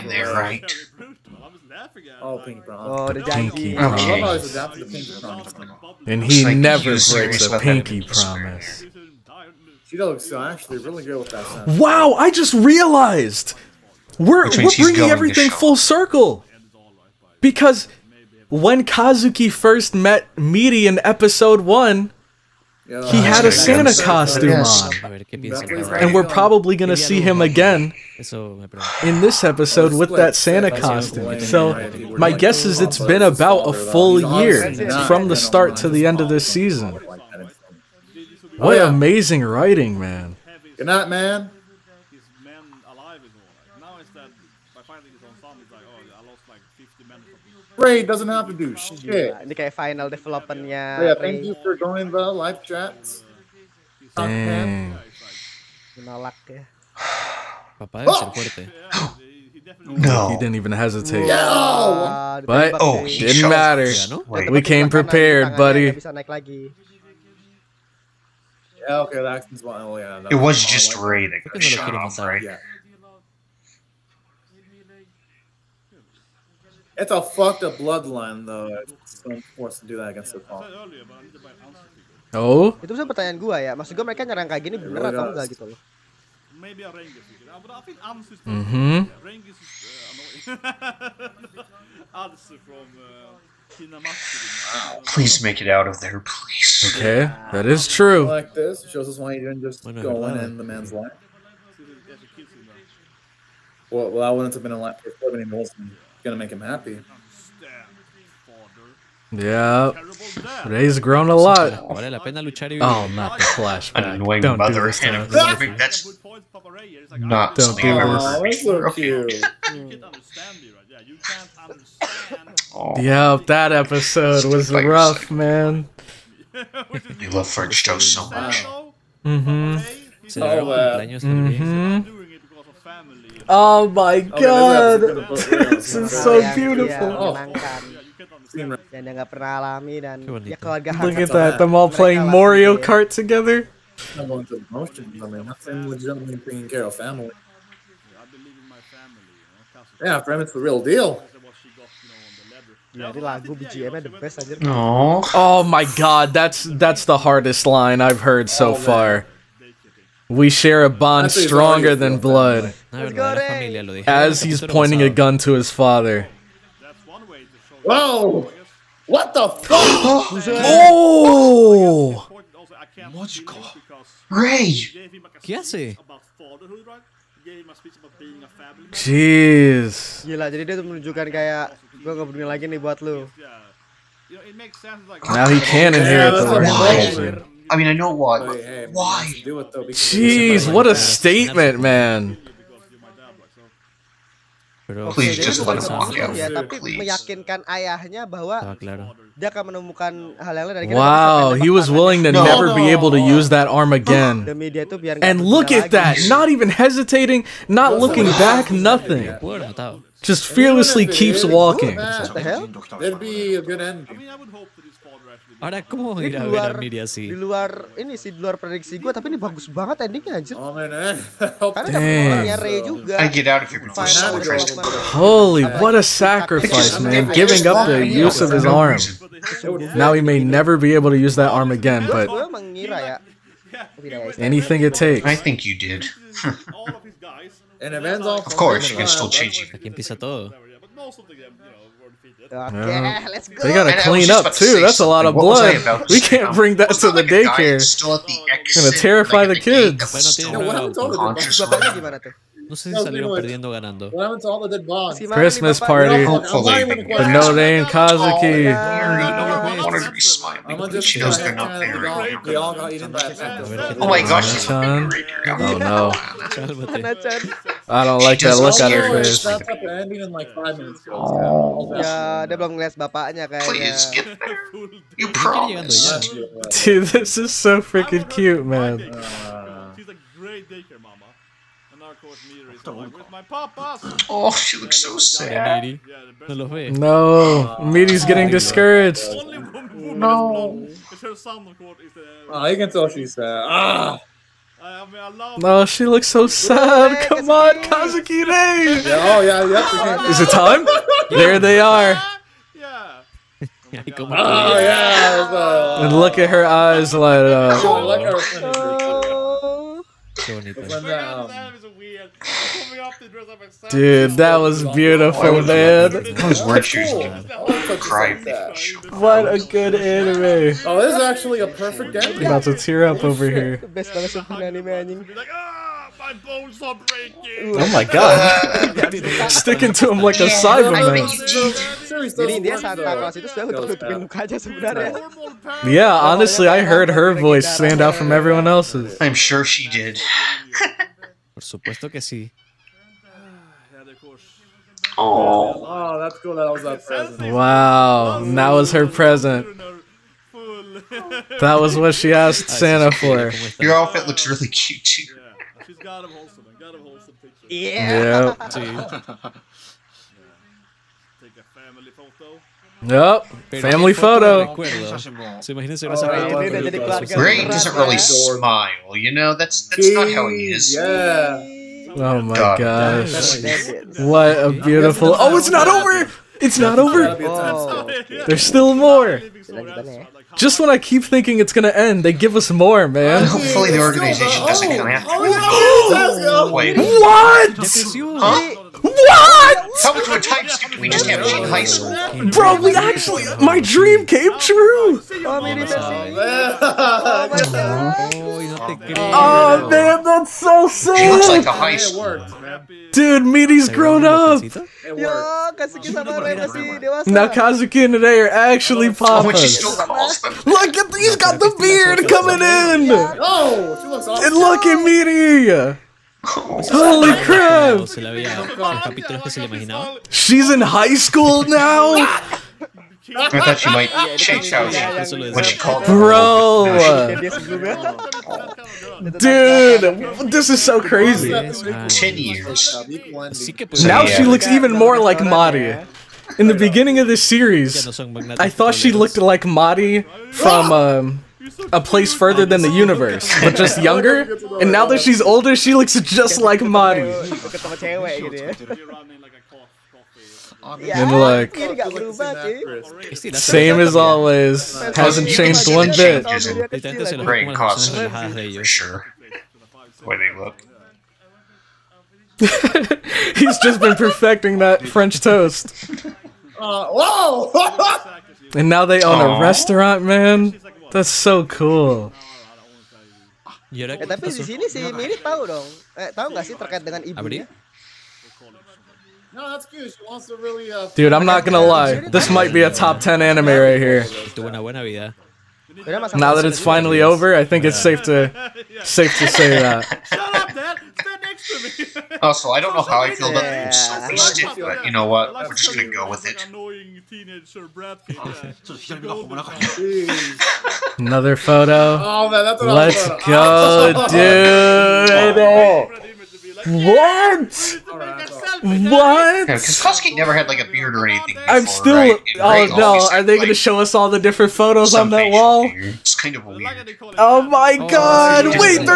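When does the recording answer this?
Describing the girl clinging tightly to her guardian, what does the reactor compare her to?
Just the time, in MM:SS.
05:30.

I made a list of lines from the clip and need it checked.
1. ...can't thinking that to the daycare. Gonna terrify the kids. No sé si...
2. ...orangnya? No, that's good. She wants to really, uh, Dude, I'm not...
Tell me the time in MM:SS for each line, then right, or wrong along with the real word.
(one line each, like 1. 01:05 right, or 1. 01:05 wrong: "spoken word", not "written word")
1. 04:06 wrong: "bring", not "thinking"
2. 07:57 wrong: "ibunya", not "orangnya".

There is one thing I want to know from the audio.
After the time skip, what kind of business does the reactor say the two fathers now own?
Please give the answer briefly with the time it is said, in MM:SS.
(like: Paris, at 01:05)
a restaurant, at 07:49.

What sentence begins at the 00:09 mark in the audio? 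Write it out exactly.
She uh, actually really good with that sound.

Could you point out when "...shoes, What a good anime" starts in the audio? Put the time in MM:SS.
05:16.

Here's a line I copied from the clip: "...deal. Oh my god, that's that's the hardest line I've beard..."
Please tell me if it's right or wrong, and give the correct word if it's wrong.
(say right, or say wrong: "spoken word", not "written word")
wrong: "heard", not "beard".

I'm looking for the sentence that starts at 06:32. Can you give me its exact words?
Bro, we actually, my dream came true.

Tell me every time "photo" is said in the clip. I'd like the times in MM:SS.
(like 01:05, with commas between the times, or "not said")
06:04, 08:21, 08:34.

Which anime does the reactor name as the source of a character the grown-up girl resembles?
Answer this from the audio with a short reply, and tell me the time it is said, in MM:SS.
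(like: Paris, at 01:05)
A Place Further than the Universe, at 07:21.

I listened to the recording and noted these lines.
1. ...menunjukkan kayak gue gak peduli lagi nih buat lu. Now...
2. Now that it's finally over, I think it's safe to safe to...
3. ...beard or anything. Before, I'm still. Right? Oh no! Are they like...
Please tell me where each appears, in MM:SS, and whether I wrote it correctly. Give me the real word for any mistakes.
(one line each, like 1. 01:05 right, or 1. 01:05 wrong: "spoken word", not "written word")
1. 03:00 right
2. 08:06 right
3. 08:30 right.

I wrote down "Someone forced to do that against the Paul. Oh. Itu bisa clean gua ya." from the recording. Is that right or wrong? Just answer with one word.
wrong.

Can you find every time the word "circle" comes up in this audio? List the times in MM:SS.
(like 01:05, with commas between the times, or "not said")
00:15.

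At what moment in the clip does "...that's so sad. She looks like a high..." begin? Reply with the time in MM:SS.
06:40.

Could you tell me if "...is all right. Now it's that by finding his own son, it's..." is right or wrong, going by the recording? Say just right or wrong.
right.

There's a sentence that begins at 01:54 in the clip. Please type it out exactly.
Annoying Don't mother do this and That's not Don't do this.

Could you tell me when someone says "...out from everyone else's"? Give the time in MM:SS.
05:38.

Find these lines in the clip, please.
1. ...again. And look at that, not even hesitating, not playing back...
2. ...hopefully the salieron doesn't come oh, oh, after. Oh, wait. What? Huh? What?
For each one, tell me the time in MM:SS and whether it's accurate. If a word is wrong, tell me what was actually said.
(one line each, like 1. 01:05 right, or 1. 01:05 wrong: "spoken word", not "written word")
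1. 03:23 wrong: "looking", not "playing"
2. 06:23 wrong: "organization", not "salieron".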